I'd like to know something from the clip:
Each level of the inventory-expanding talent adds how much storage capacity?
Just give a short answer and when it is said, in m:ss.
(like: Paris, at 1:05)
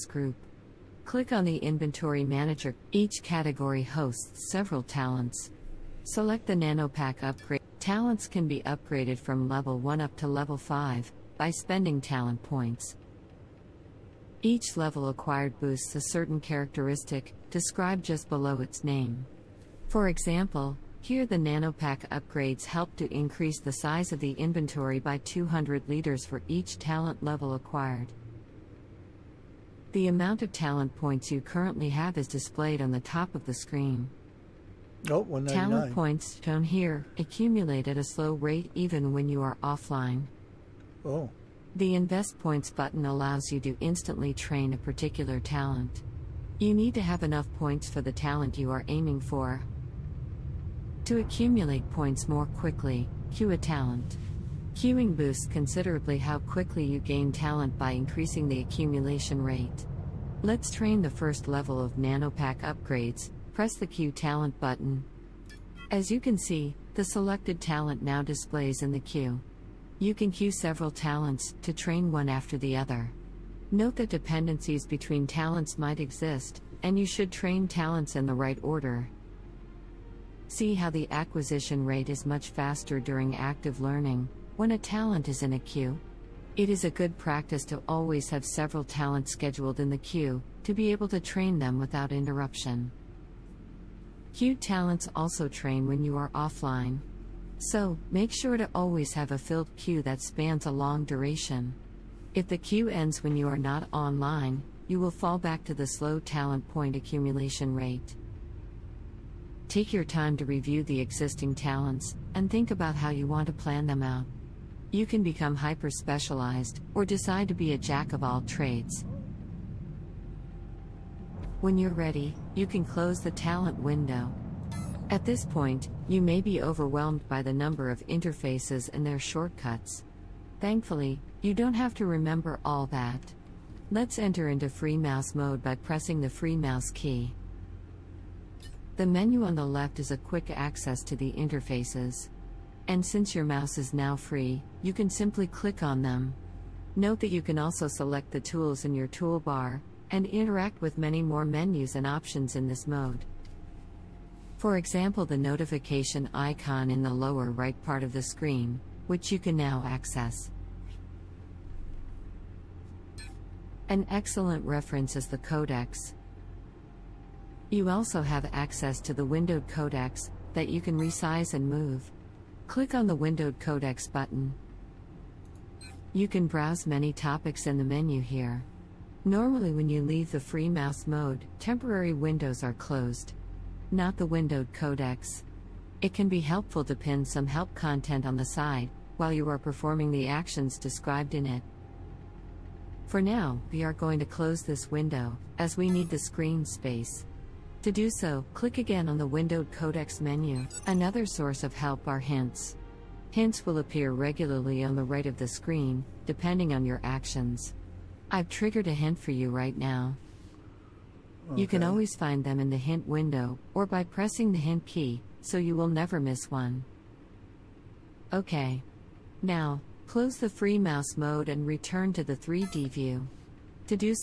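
200 liters, at 0:25.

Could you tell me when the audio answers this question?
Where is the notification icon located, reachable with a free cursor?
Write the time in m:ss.
2:37.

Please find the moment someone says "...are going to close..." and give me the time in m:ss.
3:13.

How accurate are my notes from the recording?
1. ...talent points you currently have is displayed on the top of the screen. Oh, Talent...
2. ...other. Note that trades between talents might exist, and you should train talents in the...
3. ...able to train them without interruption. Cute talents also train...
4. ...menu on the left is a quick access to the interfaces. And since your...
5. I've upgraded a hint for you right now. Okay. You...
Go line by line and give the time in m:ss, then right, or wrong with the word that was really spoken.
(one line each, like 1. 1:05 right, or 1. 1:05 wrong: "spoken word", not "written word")
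1. 0:30 right
2. 1:12 wrong: "dependencies", not "trades"
3. 1:30 right
4. 2:19 right
5. 3:28 wrong: "triggered", not "upgraded".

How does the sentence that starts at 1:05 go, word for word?
As you can see, the selected talent now displays in the queue.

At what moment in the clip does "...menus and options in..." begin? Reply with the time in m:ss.
2:31.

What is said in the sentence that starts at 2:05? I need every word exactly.
At this point, you may be overwhelmed by the number of interfaces and their shortcuts.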